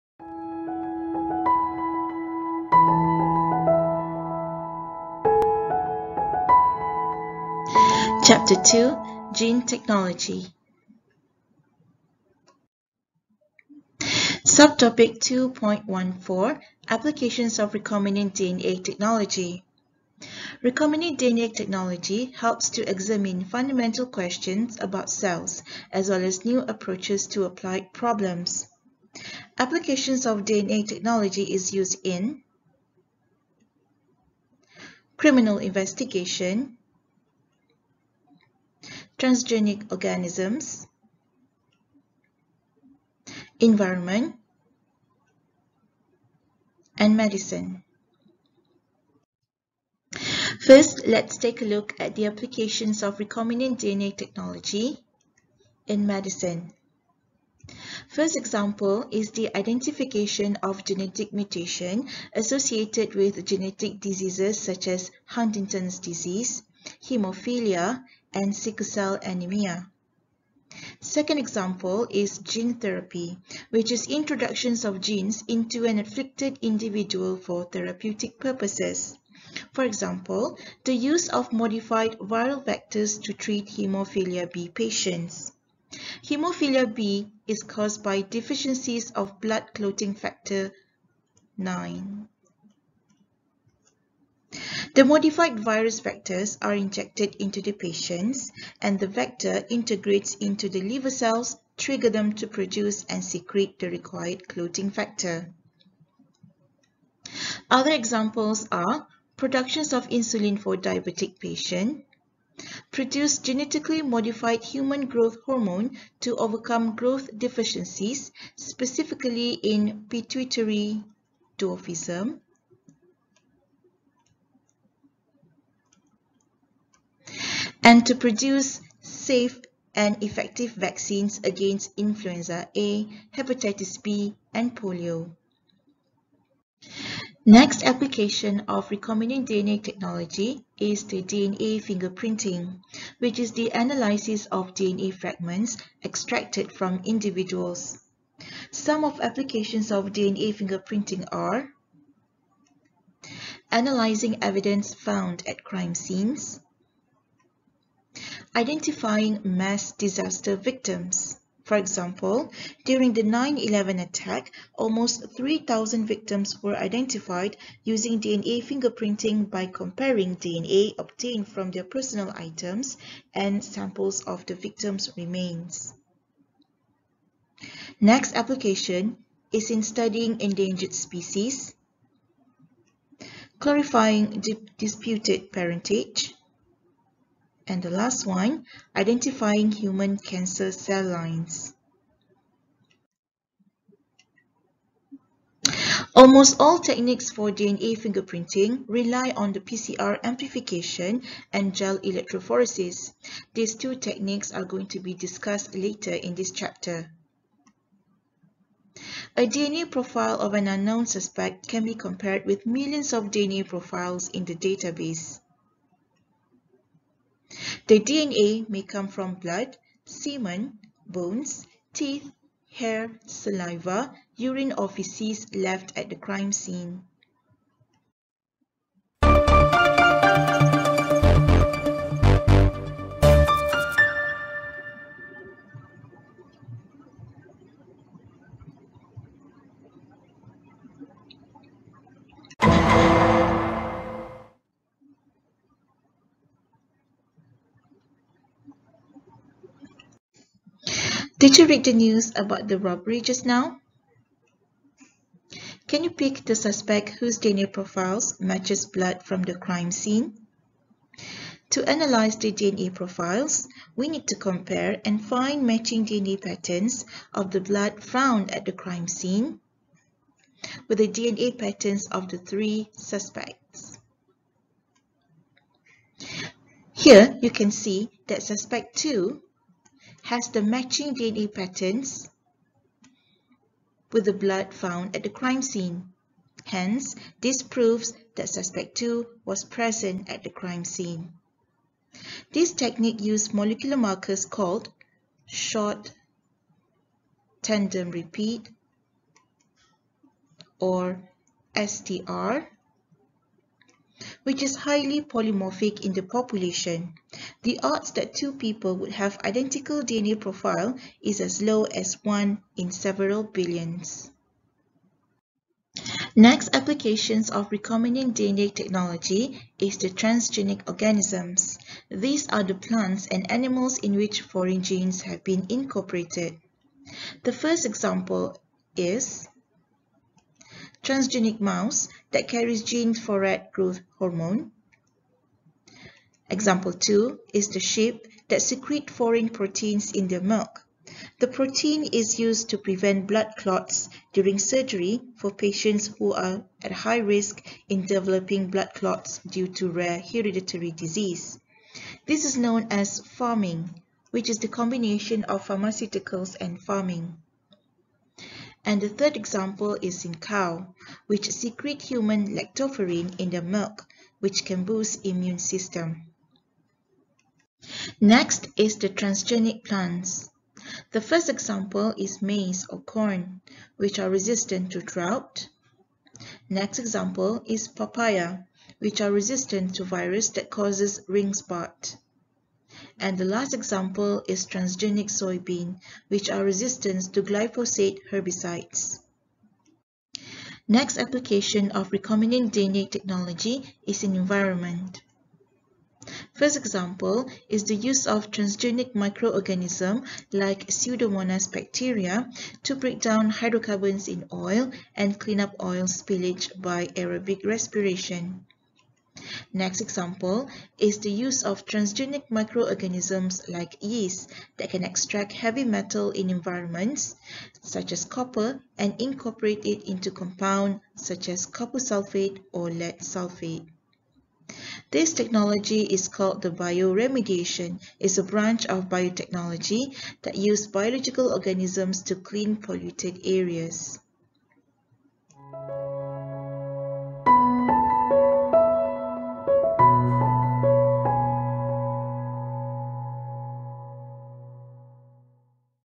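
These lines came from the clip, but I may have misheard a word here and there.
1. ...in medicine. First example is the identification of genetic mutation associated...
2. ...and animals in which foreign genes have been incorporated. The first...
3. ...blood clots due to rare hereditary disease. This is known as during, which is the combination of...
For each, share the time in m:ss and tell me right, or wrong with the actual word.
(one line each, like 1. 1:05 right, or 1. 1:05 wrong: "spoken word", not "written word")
1. 0:55 right
2. 5:23 right
3. 5:48 wrong: "pharming", not "during".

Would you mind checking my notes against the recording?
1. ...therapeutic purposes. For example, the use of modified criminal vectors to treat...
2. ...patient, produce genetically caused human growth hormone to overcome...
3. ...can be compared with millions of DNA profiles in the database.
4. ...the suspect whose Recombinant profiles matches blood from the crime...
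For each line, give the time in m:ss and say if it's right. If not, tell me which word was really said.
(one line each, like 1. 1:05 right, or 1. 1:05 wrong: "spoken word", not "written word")
1. 1:17 wrong: "viral", not "criminal"
2. 1:51 wrong: "modified", not "caused"
3. 3:31 right
4. 4:16 wrong: "DNA", not "Recombinant".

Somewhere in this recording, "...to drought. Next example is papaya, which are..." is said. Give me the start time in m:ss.
6:14.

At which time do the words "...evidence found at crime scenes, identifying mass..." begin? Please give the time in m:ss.
2:34.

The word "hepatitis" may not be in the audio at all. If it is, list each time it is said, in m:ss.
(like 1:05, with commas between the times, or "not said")
2:13.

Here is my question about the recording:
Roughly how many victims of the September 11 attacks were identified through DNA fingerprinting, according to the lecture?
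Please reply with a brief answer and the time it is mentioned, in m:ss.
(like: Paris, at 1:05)
3,000, at 2:45.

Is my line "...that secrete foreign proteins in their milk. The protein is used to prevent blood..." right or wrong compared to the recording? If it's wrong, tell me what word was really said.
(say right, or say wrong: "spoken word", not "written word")
right.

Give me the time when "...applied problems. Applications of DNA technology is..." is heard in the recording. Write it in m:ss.
0:27.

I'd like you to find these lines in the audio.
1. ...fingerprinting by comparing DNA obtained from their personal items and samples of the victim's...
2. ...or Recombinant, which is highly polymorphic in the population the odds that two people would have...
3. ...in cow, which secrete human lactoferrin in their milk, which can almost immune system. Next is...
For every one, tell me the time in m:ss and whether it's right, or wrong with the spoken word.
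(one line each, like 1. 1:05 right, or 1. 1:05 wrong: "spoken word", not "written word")
1. 2:48 right
2. 5:00 wrong: "STR", not "Recombinant"
3. 6:00 wrong: "boost", not "almost".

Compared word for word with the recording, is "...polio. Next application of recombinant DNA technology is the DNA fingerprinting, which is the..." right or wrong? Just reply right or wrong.
right.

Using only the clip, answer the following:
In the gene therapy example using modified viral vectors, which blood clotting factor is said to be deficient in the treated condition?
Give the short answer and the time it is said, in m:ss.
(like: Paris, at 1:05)
factor 9, at 1:30.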